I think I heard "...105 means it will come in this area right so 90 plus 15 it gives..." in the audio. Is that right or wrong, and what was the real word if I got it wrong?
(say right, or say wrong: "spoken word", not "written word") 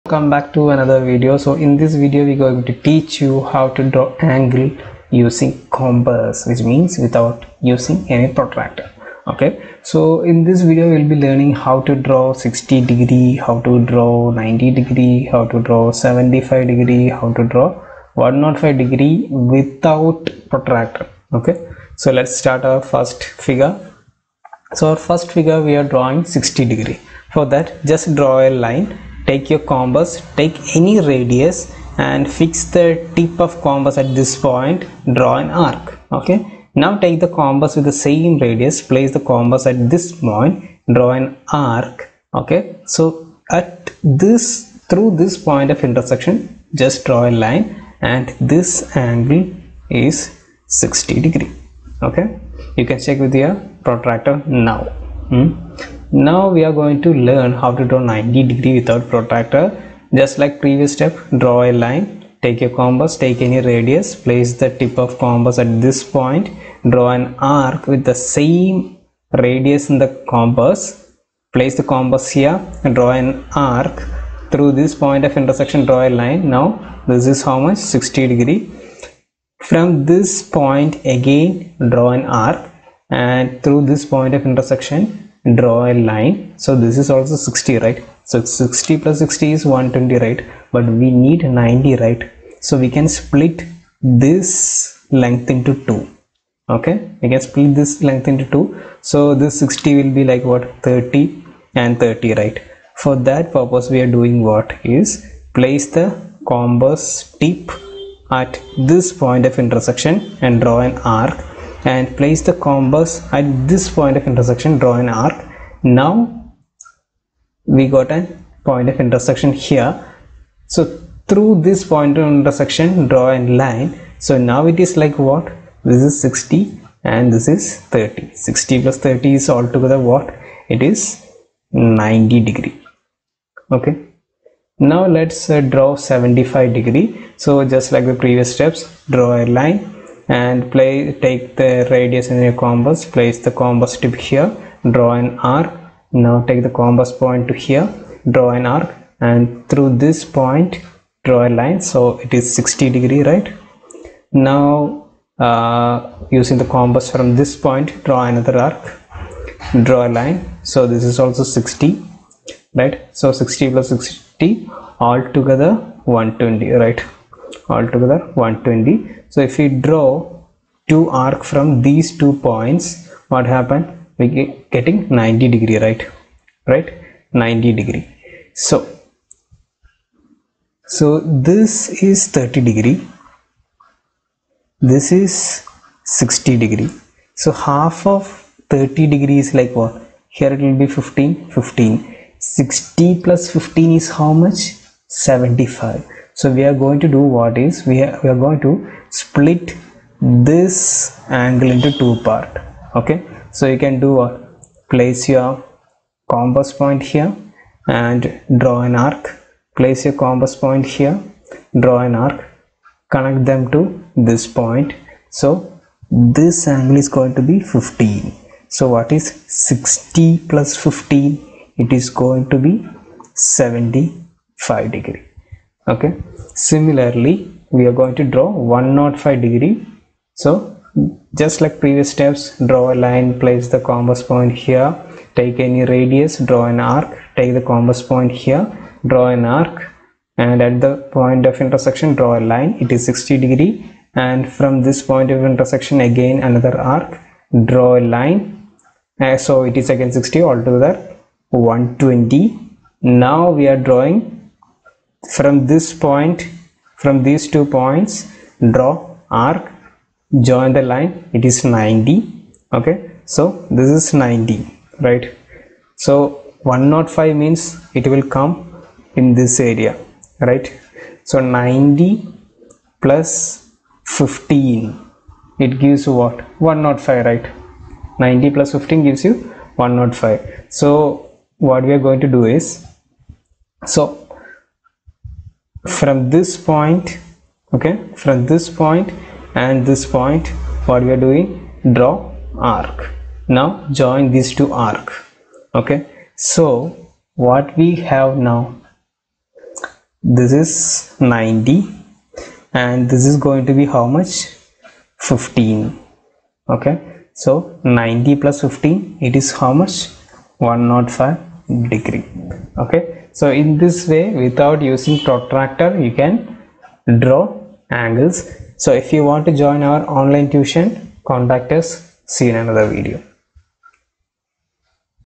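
right.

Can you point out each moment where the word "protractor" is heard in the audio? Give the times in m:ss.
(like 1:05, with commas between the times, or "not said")
0:08, 0:20, 0:53, 0:59, 5:15.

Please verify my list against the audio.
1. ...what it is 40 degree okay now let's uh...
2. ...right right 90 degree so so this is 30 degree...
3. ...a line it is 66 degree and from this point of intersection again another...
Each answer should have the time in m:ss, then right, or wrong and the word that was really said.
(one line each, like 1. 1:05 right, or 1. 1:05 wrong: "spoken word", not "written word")
1. 2:09 wrong: "90", not "40"
2. 2:55 right
3. 4:02 wrong: "60", not "66".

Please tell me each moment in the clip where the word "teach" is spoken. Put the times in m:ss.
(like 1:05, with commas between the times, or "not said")
0:02.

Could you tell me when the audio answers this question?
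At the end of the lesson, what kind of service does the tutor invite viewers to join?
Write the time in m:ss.
5:20.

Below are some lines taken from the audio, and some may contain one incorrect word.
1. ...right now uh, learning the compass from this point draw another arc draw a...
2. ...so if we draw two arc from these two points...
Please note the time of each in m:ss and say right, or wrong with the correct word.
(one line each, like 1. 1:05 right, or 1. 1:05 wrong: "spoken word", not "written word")
1. 2:33 wrong: "using", not "learning"
2. 2:49 right.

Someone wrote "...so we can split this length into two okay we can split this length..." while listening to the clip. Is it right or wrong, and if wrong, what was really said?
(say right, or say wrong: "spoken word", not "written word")
right.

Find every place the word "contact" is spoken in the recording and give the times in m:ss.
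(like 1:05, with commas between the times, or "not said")
5:21.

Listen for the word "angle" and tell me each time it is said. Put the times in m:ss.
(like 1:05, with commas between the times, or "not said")
0:04, 0:49, 3:21, 3:36, 5:18.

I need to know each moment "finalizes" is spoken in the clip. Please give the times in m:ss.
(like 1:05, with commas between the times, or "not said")
not said.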